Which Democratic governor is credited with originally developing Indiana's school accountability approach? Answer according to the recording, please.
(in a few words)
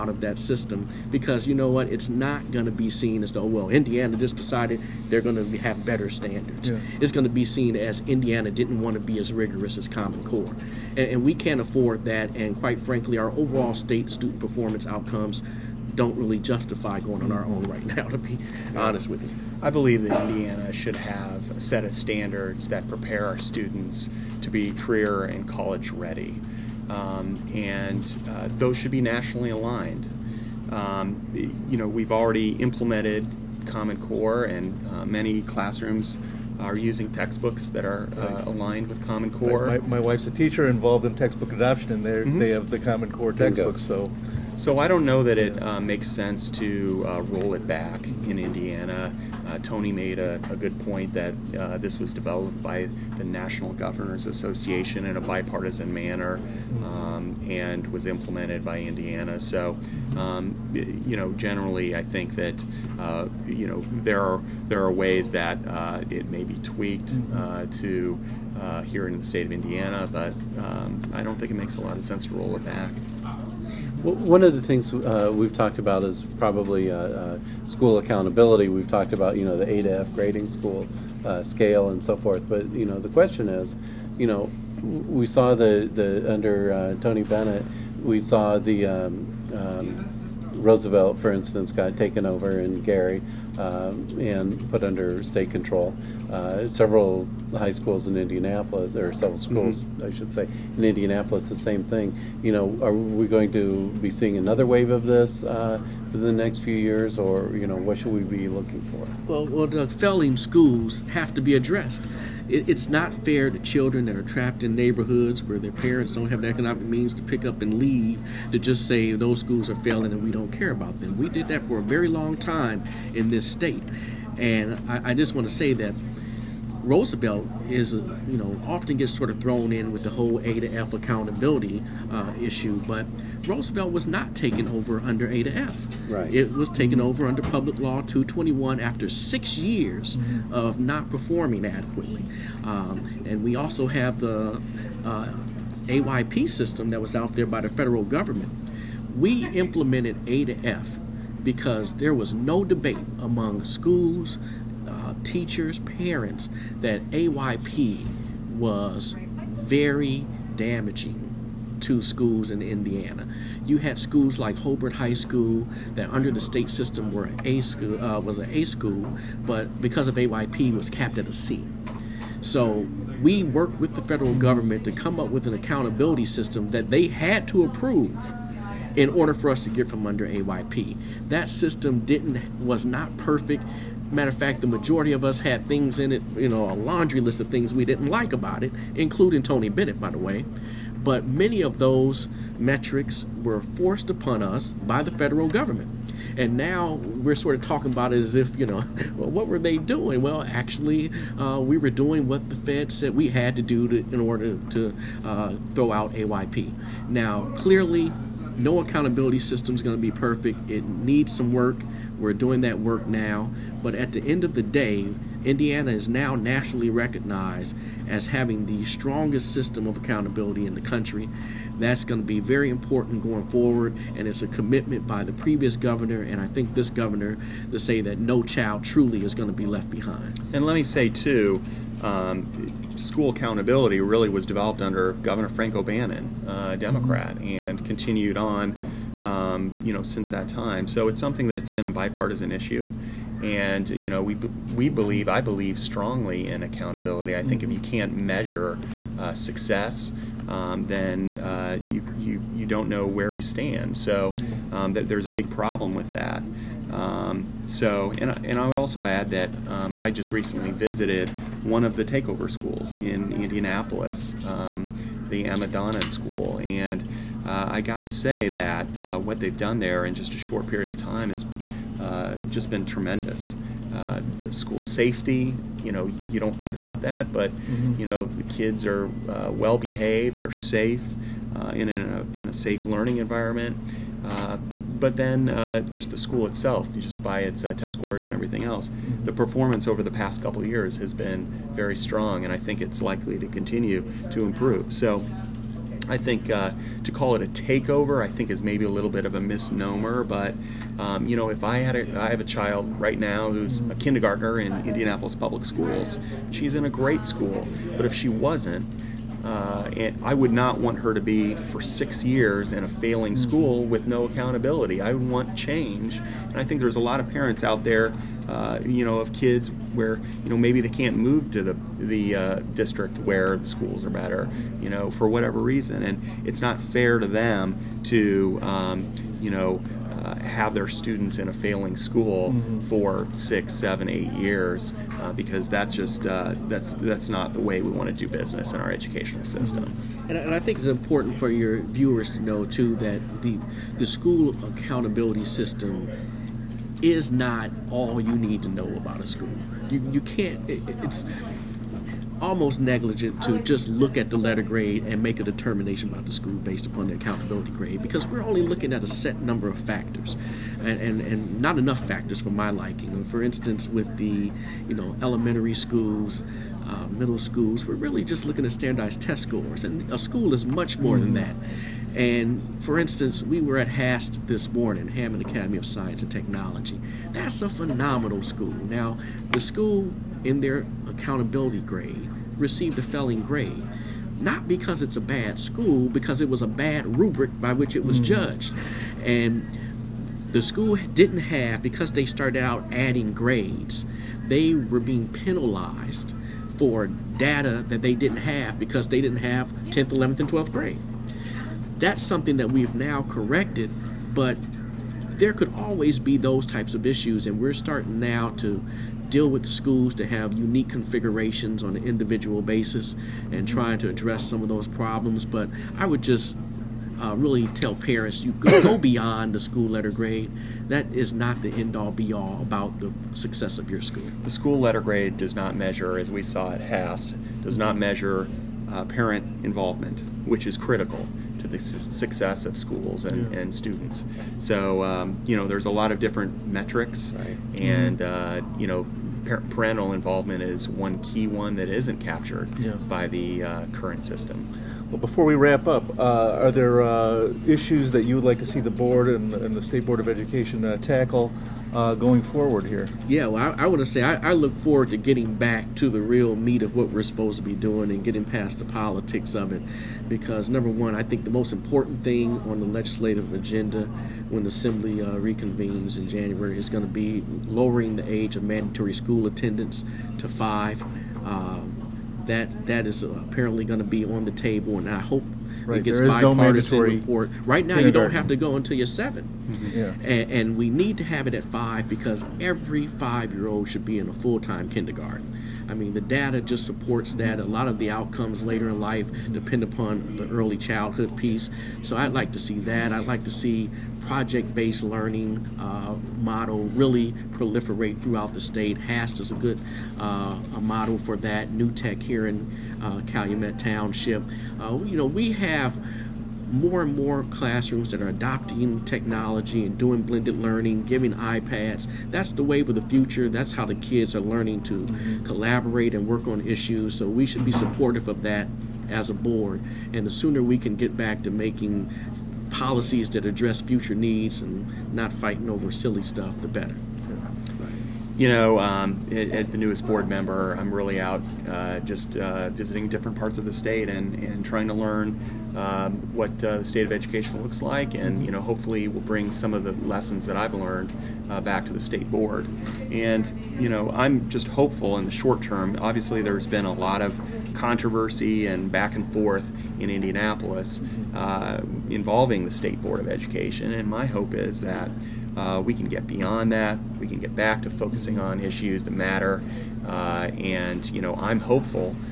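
Frank O'Bannon.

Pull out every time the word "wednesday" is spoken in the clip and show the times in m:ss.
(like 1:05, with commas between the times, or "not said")
not said.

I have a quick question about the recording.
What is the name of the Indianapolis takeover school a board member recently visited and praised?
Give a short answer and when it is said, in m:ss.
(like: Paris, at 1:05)
Emma Donnan School, at 4:25.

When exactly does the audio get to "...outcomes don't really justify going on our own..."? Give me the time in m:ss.
0:14.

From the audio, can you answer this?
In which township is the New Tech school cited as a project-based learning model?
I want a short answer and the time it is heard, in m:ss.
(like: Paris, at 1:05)
Calumet Township, at 8:23.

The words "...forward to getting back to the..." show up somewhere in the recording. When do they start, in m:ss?
7:34.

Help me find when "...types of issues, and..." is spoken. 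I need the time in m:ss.
6:46.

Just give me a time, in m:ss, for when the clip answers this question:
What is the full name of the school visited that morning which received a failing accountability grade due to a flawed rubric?
6:15.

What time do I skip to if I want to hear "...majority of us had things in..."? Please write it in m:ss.
3:04.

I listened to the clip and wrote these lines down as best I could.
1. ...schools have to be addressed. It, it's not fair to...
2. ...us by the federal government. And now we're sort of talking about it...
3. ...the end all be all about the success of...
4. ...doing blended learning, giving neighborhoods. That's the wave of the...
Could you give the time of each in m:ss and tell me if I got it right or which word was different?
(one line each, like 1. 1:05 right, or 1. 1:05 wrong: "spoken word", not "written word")
1. 1:50 right
2. 3:14 right
3. 7:01 right
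4. 8:29 wrong: "iPads", not "neighborhoods".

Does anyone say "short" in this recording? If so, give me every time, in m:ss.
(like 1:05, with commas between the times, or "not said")
4:30, 9:05.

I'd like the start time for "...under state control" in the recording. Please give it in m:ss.
1:34.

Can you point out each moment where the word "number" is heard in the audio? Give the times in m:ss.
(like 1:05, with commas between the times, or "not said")
5:59, 7:40.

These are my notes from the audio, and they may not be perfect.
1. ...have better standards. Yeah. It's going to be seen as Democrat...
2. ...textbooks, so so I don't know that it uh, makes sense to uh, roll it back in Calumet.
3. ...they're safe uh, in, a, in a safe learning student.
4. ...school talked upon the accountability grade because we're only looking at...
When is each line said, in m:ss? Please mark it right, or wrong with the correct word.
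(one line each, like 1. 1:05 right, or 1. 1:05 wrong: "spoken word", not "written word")
1. 0:05 wrong: "Indiana", not "Democrat"
2. 0:43 wrong: "Indiana", not "Calumet"
3. 4:40 wrong: "environment", not "student"
4. 5:56 wrong: "based", not "talked".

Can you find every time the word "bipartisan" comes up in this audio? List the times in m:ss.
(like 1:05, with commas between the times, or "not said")
0:55, 4:01, 7:56.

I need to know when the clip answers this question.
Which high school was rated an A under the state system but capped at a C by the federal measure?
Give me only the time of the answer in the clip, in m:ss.
2:44.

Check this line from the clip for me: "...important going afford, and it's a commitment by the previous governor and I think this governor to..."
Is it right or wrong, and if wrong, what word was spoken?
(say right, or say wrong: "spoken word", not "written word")
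wrong: "forward", not "afford".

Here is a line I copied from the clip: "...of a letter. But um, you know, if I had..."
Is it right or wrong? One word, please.
wrong.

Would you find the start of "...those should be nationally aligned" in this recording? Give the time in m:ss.
0:28.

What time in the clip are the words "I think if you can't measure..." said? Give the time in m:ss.
4:07.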